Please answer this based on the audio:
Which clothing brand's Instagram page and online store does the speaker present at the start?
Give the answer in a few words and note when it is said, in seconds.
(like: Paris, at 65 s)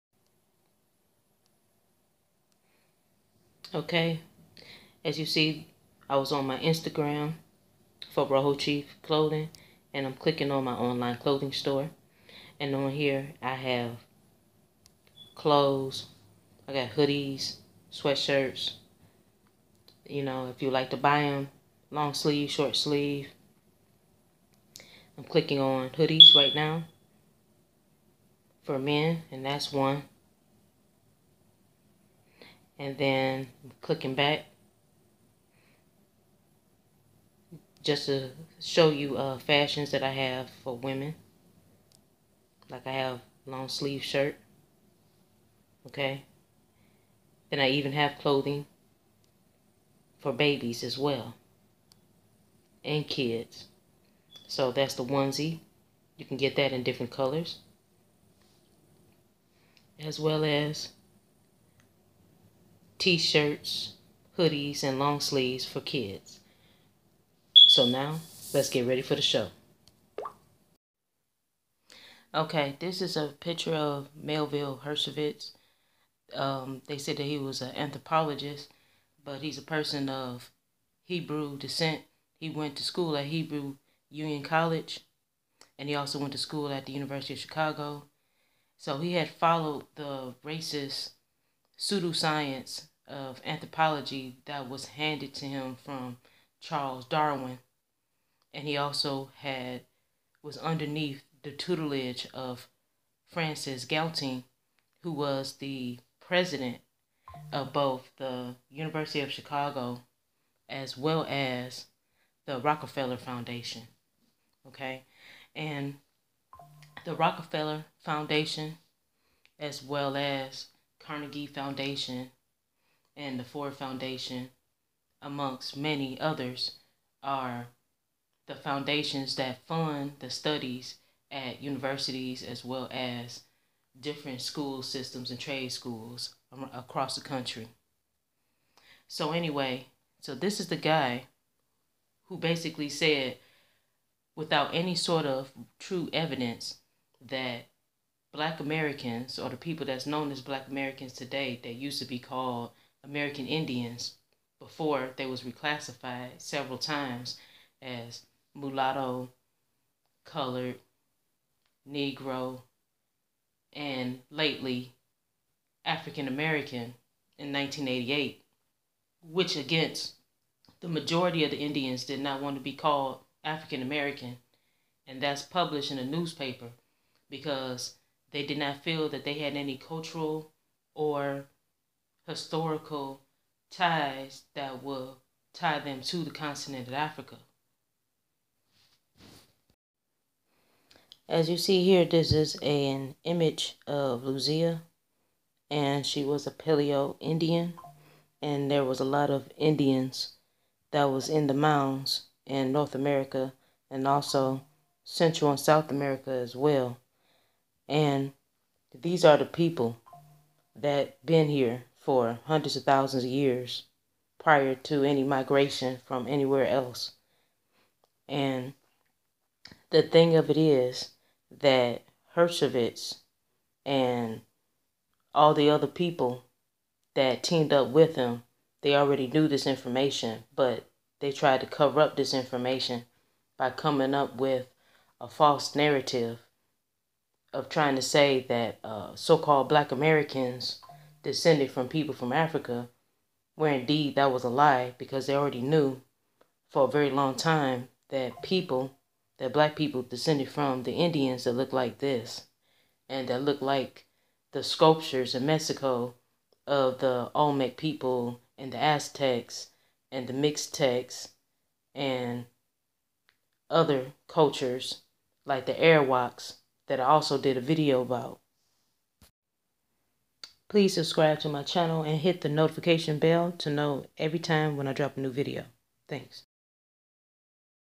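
Rojo Chief Clothing, at 8 s.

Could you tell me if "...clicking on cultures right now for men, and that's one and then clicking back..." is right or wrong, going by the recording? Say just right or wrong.
wrong.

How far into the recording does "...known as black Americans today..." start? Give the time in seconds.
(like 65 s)
150 s.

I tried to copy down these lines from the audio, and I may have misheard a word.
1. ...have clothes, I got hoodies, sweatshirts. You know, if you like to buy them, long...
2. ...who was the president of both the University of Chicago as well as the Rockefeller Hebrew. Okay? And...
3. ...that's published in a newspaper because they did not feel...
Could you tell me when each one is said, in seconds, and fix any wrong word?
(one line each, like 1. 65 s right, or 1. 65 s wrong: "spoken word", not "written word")
1. 13 s right
2. 105 s wrong: "Foundation", not "Hebrew"
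3. 175 s right.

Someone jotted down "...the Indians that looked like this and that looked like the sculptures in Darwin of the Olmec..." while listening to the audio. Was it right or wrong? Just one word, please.
wrong.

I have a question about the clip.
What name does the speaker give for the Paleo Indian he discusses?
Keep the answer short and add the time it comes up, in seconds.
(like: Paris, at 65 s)
Luzia, at 194 s.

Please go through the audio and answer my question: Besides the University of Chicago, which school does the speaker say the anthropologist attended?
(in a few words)
Hebrew Union College.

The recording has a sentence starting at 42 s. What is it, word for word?
Like I have long sleeve shirt.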